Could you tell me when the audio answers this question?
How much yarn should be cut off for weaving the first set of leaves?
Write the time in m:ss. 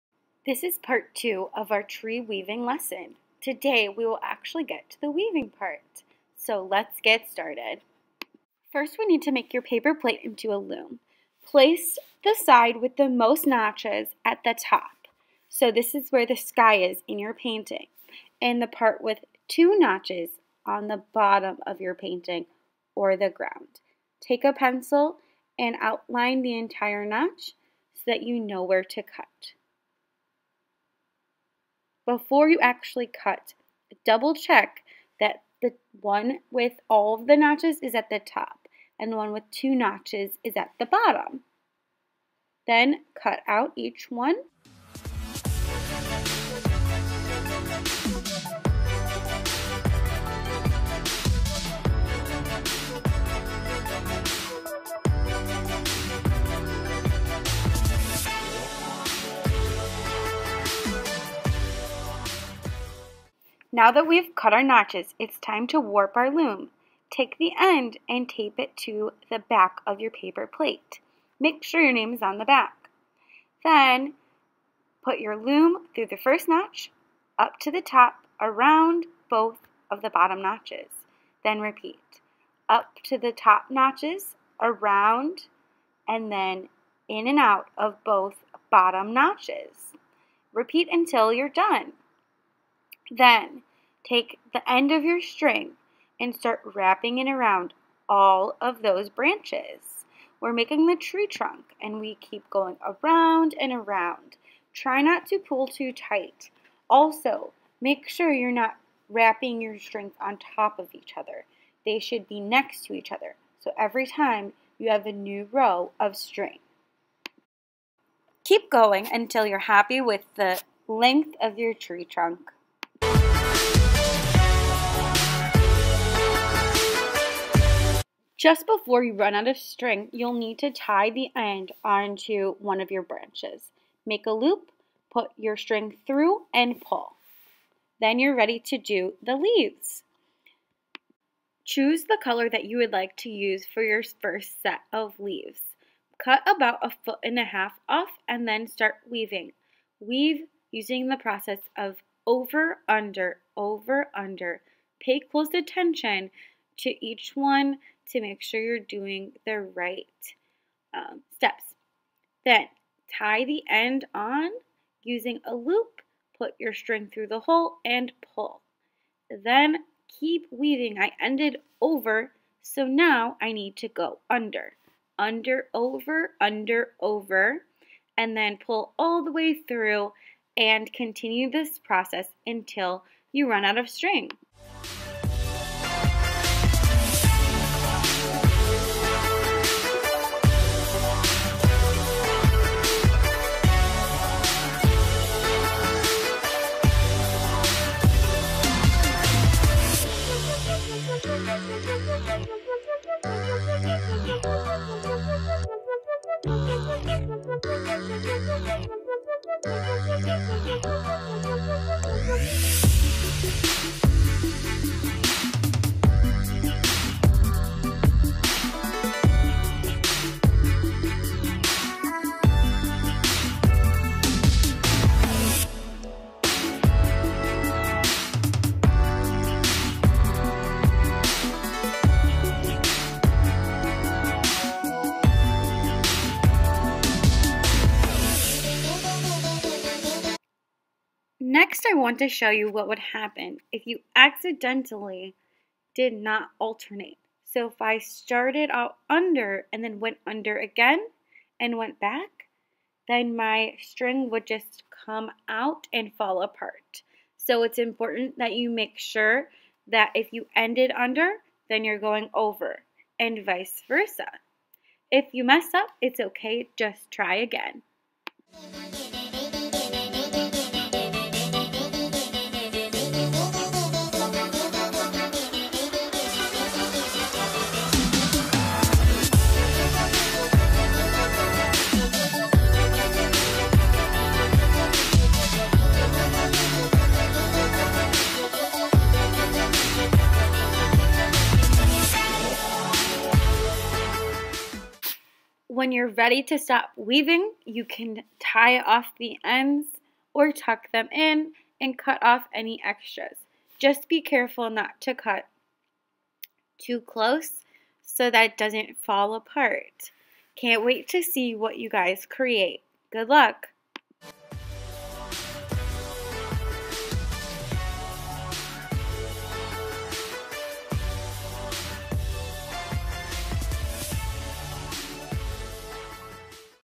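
2:26.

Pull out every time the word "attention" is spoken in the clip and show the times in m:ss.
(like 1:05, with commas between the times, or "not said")
2:35.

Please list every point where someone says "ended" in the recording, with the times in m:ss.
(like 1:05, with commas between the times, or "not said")
2:51, 4:20.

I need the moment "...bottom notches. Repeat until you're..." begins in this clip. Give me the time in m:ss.
1:28.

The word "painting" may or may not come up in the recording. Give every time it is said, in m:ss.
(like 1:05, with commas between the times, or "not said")
0:17, 0:21.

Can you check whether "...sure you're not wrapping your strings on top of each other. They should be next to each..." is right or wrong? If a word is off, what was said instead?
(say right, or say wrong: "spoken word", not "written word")
right.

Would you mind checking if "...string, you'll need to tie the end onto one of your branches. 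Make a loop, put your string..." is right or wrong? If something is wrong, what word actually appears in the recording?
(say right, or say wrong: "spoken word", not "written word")
right.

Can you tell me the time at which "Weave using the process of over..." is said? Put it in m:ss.
2:29.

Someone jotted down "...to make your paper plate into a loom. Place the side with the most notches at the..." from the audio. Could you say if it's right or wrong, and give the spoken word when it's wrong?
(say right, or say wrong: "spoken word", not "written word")
right.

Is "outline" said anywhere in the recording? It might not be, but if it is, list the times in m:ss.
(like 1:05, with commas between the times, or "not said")
0:25.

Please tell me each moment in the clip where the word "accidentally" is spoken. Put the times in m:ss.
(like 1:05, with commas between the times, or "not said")
4:04.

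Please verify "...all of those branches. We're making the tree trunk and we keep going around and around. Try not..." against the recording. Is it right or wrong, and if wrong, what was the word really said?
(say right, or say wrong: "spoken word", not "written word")
right.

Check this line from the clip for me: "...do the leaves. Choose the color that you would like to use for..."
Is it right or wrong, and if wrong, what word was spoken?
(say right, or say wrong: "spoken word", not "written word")
right.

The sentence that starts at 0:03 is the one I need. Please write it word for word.
Today we will actually get to the weaving part.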